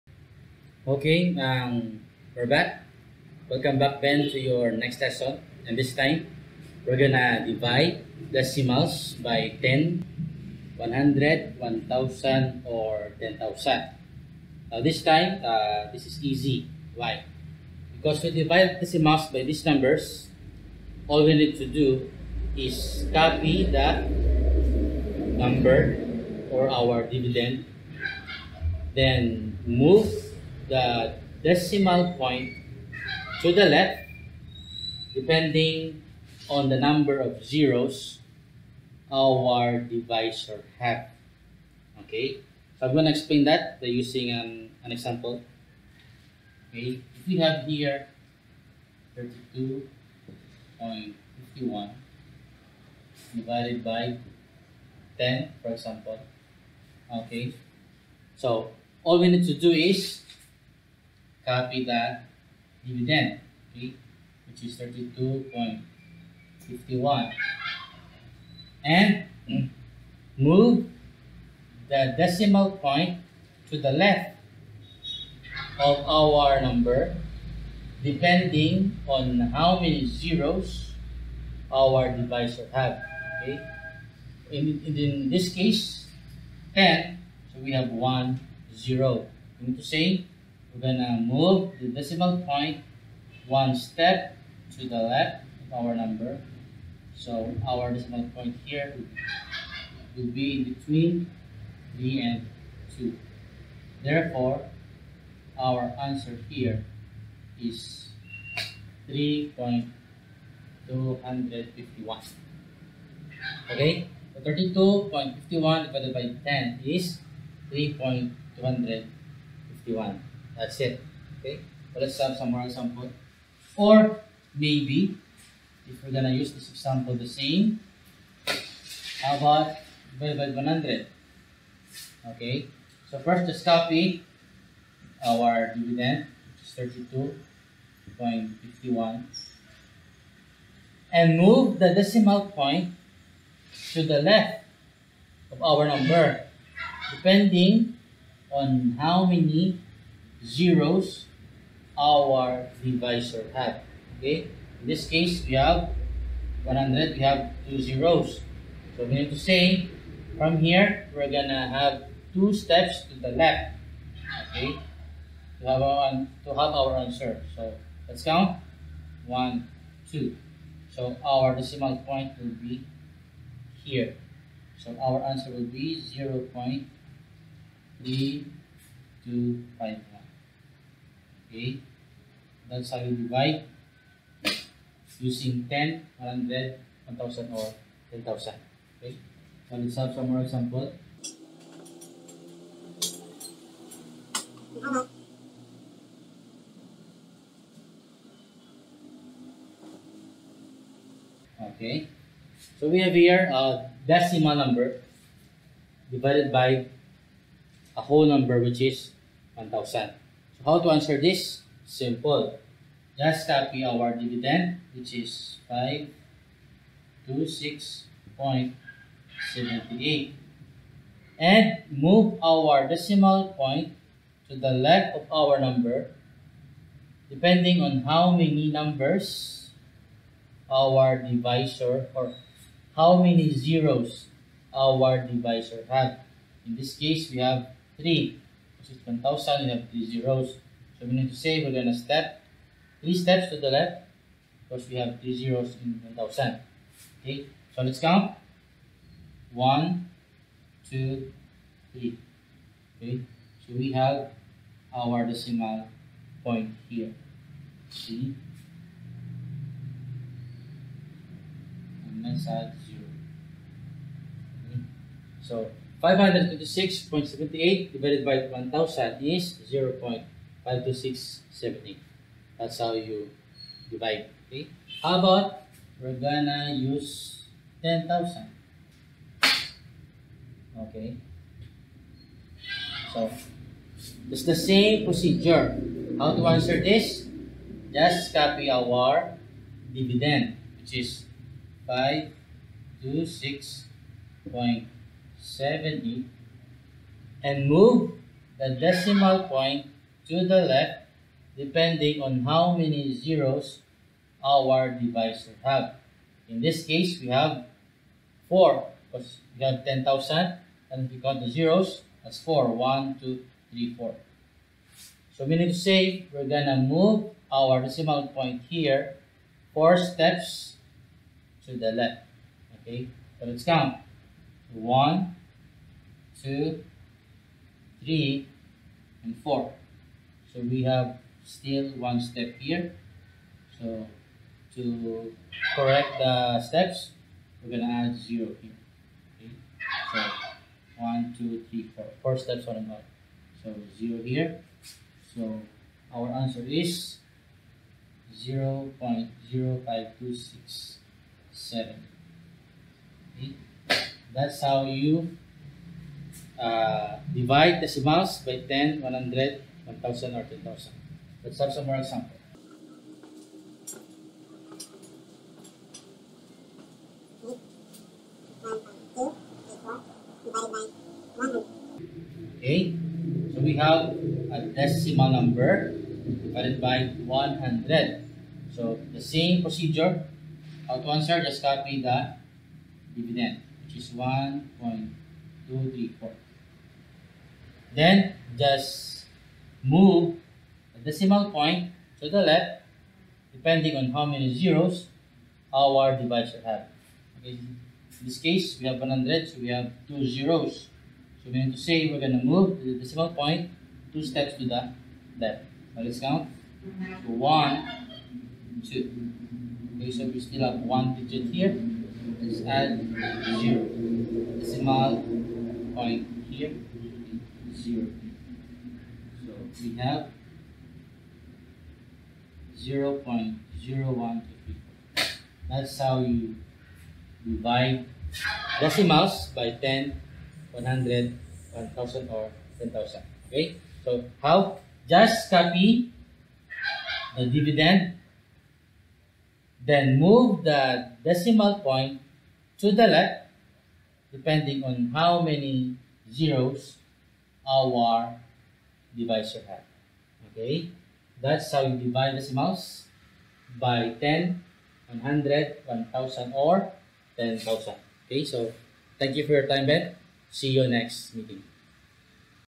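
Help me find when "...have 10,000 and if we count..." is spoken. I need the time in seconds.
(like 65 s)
309 s.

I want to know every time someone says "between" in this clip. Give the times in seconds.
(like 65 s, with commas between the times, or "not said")
100 s.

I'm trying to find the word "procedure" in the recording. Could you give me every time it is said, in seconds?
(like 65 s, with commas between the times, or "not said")
285 s, 379 s.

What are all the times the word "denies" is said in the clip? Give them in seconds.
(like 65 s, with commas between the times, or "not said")
not said.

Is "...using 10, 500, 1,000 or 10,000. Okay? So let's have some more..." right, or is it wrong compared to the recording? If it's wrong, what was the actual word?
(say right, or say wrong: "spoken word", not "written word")
wrong: "100", not "500".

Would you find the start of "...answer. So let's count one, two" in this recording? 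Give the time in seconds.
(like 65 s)
167 s.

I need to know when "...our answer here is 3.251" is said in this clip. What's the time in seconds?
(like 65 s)
105 s.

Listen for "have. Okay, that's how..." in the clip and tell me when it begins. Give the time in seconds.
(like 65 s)
449 s.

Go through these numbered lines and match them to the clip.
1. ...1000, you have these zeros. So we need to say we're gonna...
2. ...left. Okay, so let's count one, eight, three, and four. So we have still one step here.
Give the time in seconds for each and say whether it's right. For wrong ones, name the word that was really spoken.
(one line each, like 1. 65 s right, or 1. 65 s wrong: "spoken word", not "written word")
1. 239 s right
2. 321 s wrong: "two", not "eight".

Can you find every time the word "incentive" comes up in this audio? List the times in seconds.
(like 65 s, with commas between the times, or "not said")
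not said.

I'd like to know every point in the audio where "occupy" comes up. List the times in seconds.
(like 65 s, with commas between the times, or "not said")
not said.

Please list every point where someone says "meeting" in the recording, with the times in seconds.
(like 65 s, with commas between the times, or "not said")
461 s.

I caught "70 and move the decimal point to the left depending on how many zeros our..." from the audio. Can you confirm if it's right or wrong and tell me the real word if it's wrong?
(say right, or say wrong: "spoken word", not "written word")
right.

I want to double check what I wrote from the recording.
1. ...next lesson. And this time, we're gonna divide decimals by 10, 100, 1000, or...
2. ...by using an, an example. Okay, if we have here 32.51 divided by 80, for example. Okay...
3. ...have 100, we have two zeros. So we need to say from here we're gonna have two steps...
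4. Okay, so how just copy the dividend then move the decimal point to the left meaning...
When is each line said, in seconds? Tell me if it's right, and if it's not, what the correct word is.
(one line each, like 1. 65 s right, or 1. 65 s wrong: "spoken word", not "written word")
1. 4 s right
2. 43 s wrong: "10", not "80"
3. 155 s right
4. 433 s wrong: "depending", not "meaning".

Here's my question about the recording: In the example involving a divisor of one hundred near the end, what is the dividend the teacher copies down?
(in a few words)
1.234.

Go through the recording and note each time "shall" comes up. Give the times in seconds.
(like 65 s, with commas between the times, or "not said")
182 s.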